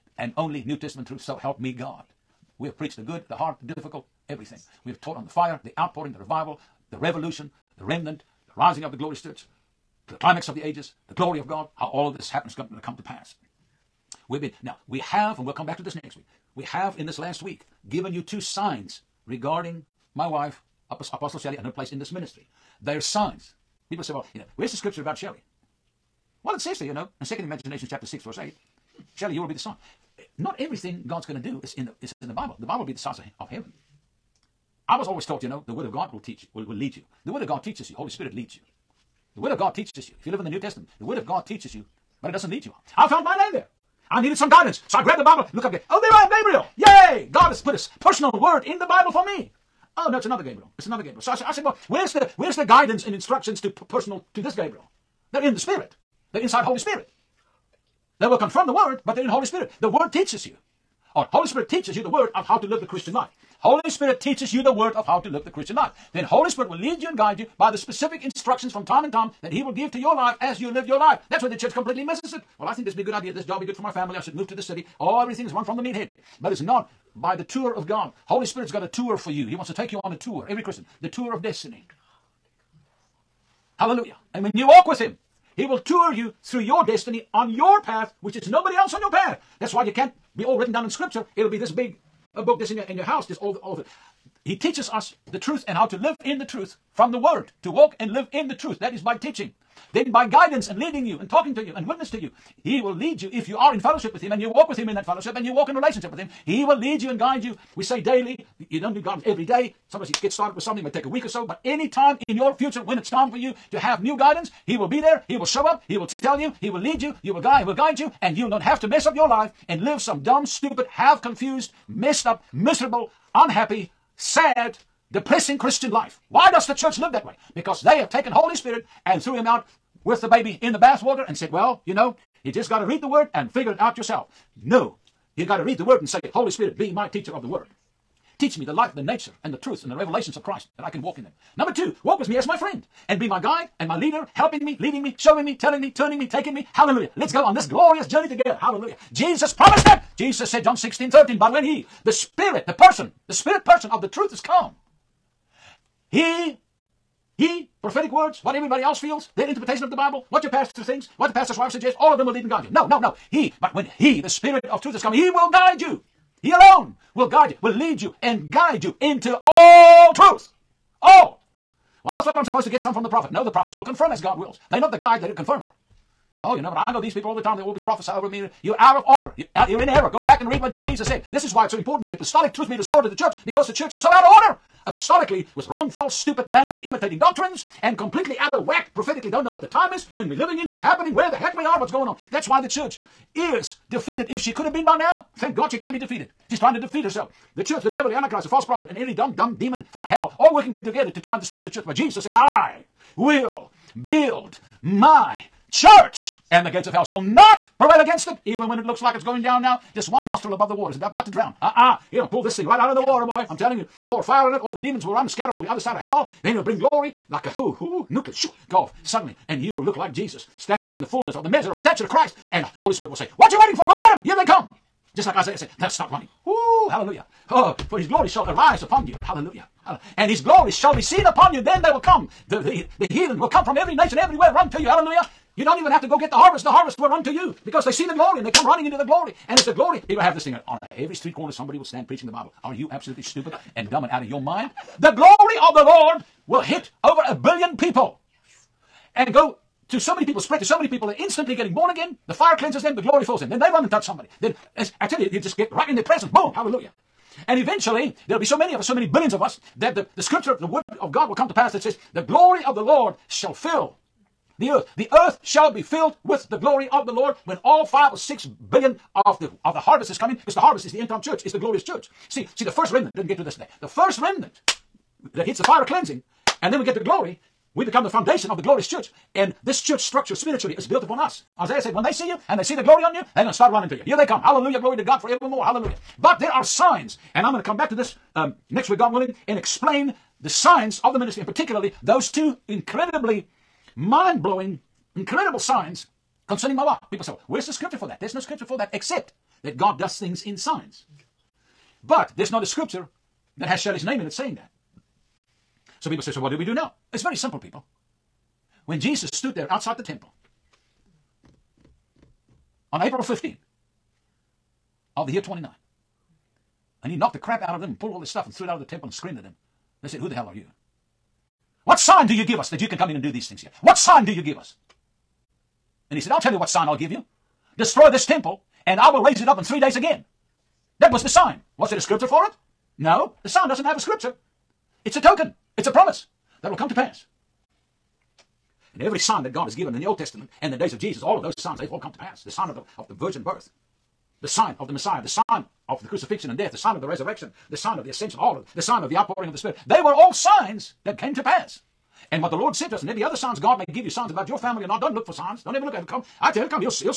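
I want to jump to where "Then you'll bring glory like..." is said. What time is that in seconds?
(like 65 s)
216 s.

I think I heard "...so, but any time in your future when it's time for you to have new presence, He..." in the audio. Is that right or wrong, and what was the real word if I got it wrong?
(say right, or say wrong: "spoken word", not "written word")
wrong: "guidance", not "presence".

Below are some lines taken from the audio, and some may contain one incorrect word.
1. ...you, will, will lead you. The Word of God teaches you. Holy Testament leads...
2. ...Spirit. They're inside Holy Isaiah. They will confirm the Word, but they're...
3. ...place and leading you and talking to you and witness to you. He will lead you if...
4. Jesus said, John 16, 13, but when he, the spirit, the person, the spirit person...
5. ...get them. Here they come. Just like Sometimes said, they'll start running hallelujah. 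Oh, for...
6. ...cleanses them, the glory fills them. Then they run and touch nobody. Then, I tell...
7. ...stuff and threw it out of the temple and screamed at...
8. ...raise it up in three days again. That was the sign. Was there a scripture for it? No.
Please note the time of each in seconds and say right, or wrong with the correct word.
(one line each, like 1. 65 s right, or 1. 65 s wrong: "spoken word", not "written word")
1. 36 s wrong: "Spirit", not "Testament"
2. 55 s wrong: "Spirit", not "Isaiah"
3. 100 s wrong: "guidance", not "place"
4. 150 s right
5. 223 s wrong: "Isaiah", not "Sometimes"
6. 252 s wrong: "somebody", not "nobody"
7. 318 s right
8. 329 s right.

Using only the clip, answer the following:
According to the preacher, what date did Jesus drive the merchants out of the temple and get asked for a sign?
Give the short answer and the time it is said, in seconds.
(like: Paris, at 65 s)
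April 15, 29, at 313 s.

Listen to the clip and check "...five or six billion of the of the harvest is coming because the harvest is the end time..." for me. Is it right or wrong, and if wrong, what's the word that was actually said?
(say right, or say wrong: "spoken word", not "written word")
right.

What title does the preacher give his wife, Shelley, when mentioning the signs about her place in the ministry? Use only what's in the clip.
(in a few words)
Apostle.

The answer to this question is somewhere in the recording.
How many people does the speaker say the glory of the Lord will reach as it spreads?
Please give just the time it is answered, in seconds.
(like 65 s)
247 s.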